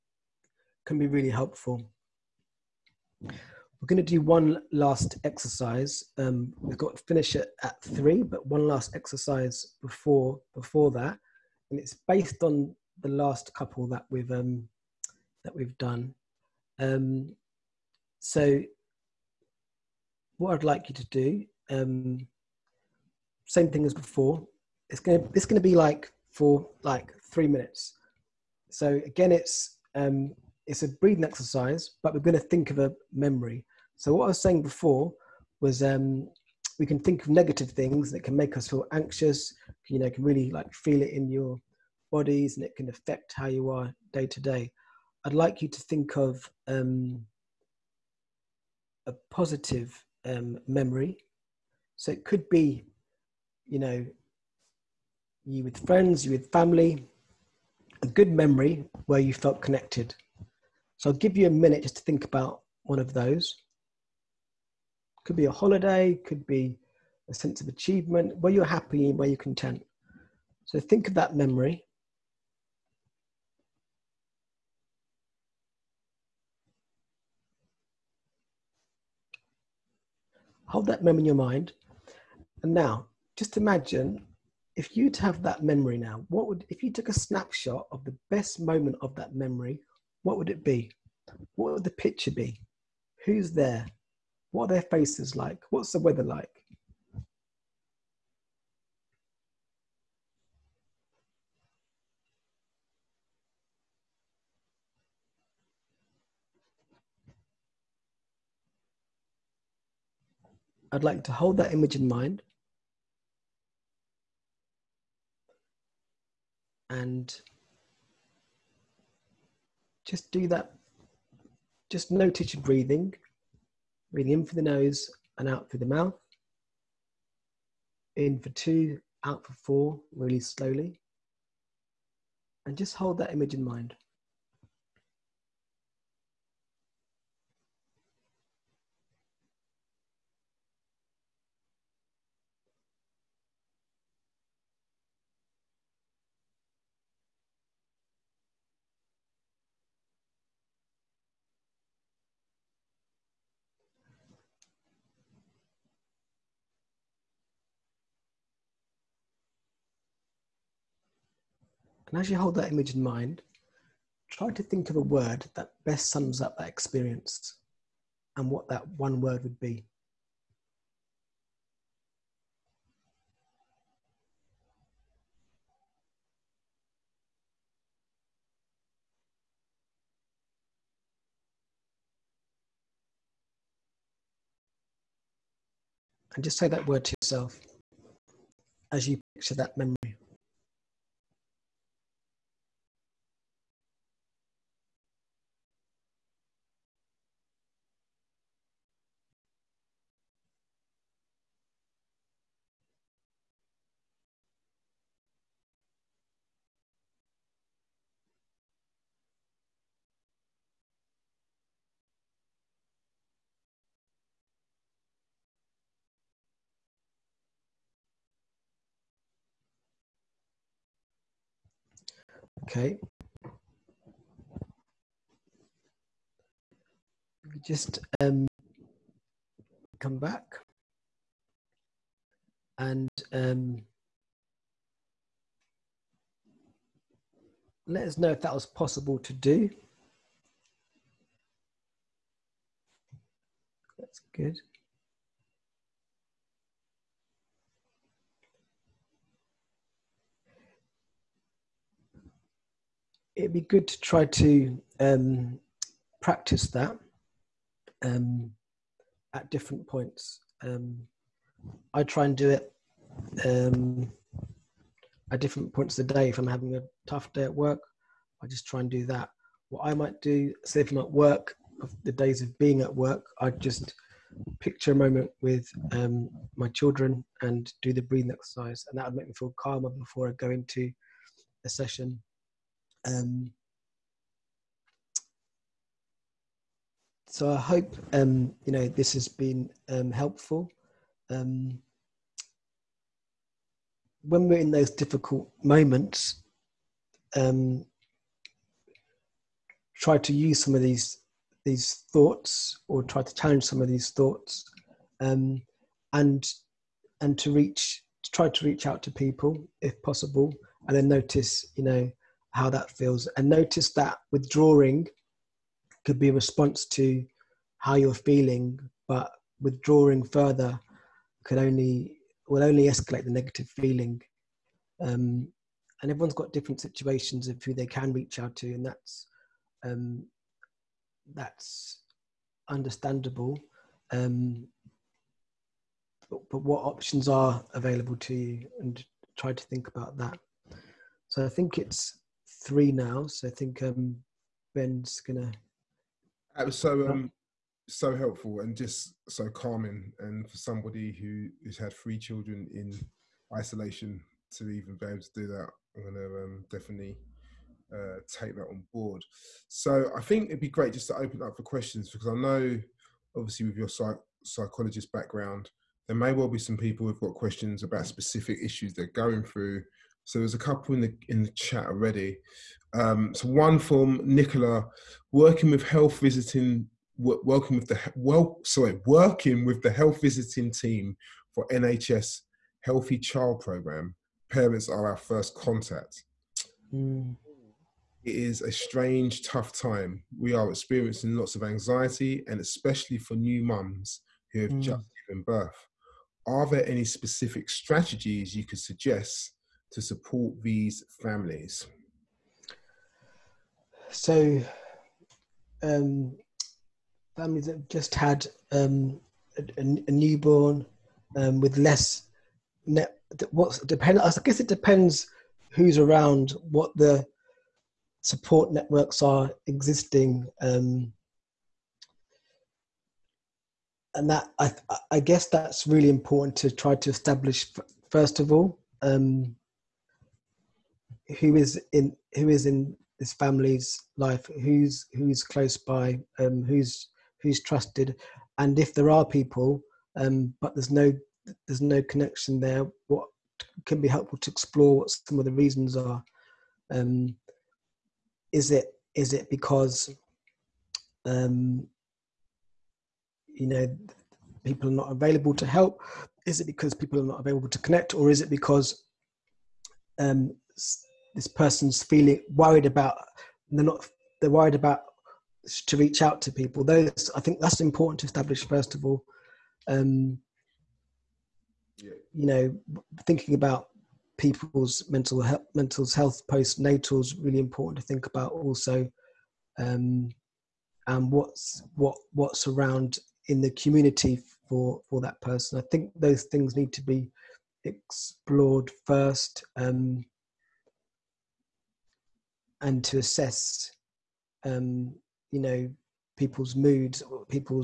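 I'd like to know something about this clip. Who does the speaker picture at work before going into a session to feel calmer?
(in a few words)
my children.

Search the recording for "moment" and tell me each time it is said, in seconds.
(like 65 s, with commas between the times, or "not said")
88 s, 274 s, 295 s.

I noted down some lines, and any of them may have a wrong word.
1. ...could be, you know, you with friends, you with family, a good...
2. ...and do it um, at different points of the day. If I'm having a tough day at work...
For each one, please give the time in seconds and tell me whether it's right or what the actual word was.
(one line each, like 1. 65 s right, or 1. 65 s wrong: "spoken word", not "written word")
1. 52 s right
2. 262 s right.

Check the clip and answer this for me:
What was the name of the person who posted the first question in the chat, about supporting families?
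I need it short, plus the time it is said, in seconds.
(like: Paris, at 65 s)
Nicola, at 374 s.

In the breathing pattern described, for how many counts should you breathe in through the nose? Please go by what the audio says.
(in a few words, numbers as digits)
2.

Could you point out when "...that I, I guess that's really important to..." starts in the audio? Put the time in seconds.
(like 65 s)
424 s.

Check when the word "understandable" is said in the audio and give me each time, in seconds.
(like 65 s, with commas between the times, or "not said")
332 s.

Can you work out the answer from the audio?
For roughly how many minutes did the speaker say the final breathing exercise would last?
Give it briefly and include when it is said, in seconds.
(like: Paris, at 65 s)
3, at 27 s.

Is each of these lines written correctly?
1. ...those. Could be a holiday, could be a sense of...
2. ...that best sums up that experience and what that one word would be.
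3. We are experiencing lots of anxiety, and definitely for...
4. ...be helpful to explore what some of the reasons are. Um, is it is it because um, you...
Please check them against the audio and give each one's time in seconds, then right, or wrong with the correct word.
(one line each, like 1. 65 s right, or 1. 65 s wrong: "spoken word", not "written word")
1. 63 s right
2. 165 s right
3. 390 s wrong: "especially", not "definitely"
4. 444 s right.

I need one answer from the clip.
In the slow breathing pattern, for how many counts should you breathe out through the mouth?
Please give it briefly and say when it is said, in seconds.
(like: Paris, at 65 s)
4, at 129 s.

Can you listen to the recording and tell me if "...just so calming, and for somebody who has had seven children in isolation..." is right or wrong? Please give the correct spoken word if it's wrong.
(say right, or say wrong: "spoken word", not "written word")
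wrong: "three", not "seven".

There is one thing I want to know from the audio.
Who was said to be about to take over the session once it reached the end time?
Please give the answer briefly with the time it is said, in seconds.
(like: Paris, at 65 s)
Ben, at 344 s.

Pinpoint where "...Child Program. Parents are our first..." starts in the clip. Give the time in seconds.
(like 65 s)
383 s.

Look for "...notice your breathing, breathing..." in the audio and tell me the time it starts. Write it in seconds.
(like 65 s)
122 s.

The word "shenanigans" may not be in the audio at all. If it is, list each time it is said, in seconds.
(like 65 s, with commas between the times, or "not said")
not said.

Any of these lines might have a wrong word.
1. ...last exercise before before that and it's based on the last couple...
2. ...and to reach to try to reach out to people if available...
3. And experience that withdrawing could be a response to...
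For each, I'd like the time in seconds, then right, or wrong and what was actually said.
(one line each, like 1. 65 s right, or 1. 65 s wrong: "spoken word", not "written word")
1. 8 s right
2. 307 s wrong: "possible", not "available"
3. 313 s wrong: "notice", not "experience".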